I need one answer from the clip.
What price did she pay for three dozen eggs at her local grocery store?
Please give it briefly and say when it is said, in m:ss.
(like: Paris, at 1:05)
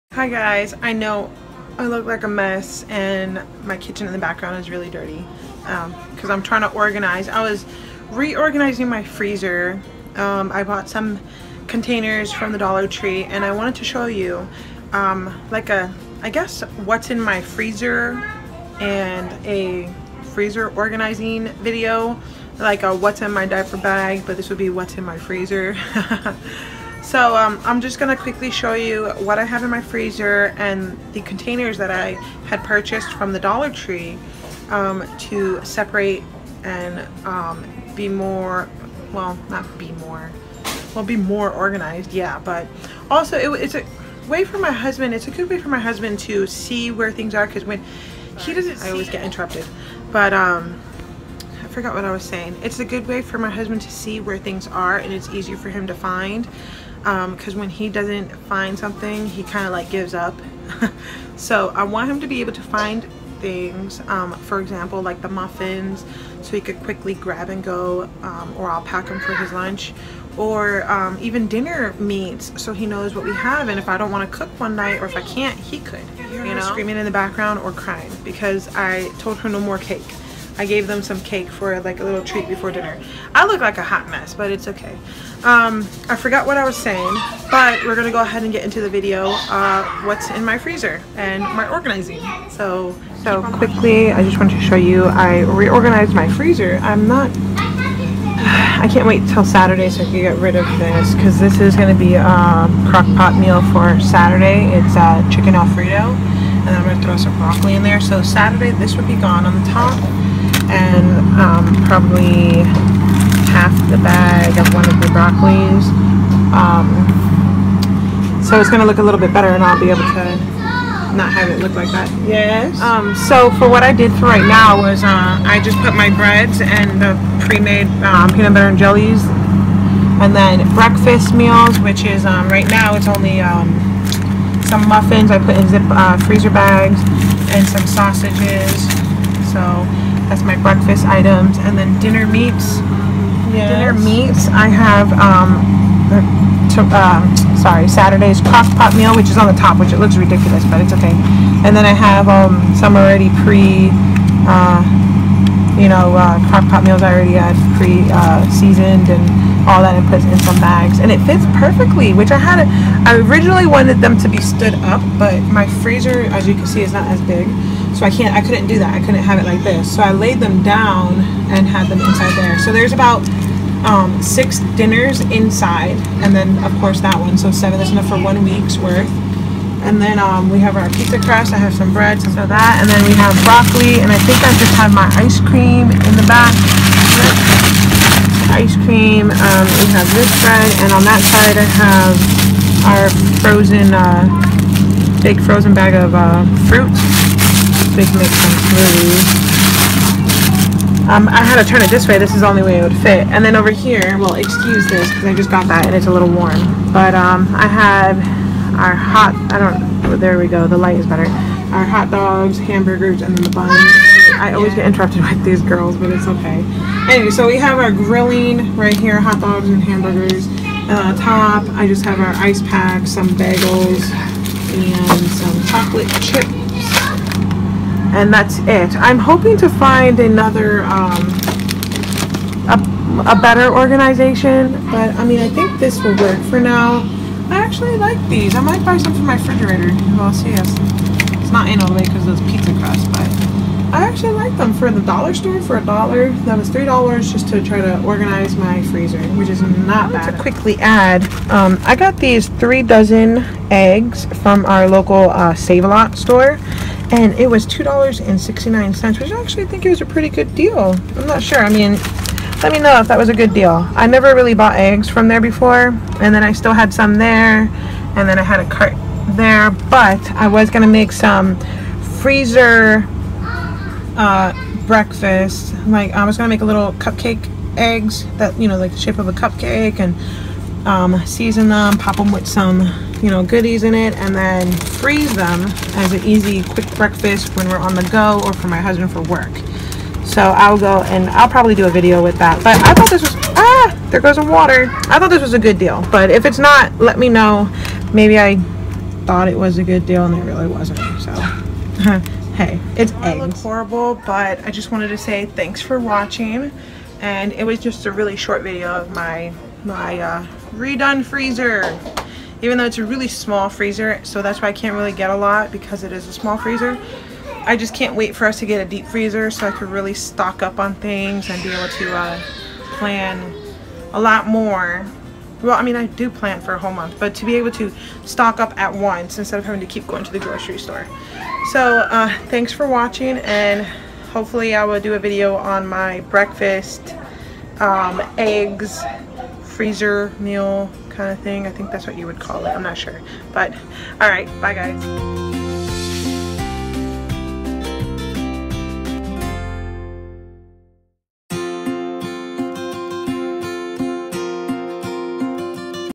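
$2.69, at 4:17.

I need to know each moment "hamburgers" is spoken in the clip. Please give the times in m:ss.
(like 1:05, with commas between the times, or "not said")
3:32, 3:39.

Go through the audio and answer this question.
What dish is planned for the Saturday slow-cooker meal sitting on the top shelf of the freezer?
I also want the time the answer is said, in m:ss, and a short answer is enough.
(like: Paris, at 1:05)
Chicken alfredo, at 1:45.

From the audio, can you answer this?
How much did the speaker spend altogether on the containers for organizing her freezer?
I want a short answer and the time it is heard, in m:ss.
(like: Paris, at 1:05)
$3, at 4:06.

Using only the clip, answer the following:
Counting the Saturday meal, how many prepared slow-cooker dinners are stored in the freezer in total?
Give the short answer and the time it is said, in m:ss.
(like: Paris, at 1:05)
7, at 2:57.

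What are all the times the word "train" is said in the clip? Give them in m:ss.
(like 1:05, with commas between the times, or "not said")
not said.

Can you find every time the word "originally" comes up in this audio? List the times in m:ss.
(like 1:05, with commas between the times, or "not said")
2:43.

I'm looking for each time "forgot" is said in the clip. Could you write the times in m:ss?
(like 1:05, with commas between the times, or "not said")
0:51, 1:26.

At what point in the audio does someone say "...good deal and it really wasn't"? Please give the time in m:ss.
4:59.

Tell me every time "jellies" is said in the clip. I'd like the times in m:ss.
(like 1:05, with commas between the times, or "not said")
2:08.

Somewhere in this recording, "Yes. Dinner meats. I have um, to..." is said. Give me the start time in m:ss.
2:23.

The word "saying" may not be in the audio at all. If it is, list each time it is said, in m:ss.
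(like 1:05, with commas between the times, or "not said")
0:52, 1:26.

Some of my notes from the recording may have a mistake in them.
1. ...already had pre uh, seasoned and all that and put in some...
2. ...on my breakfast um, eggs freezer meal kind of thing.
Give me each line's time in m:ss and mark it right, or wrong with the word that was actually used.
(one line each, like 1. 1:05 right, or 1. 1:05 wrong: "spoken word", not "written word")
1. 2:37 right
2. 5:35 right.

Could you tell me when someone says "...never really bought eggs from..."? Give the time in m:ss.
4:24.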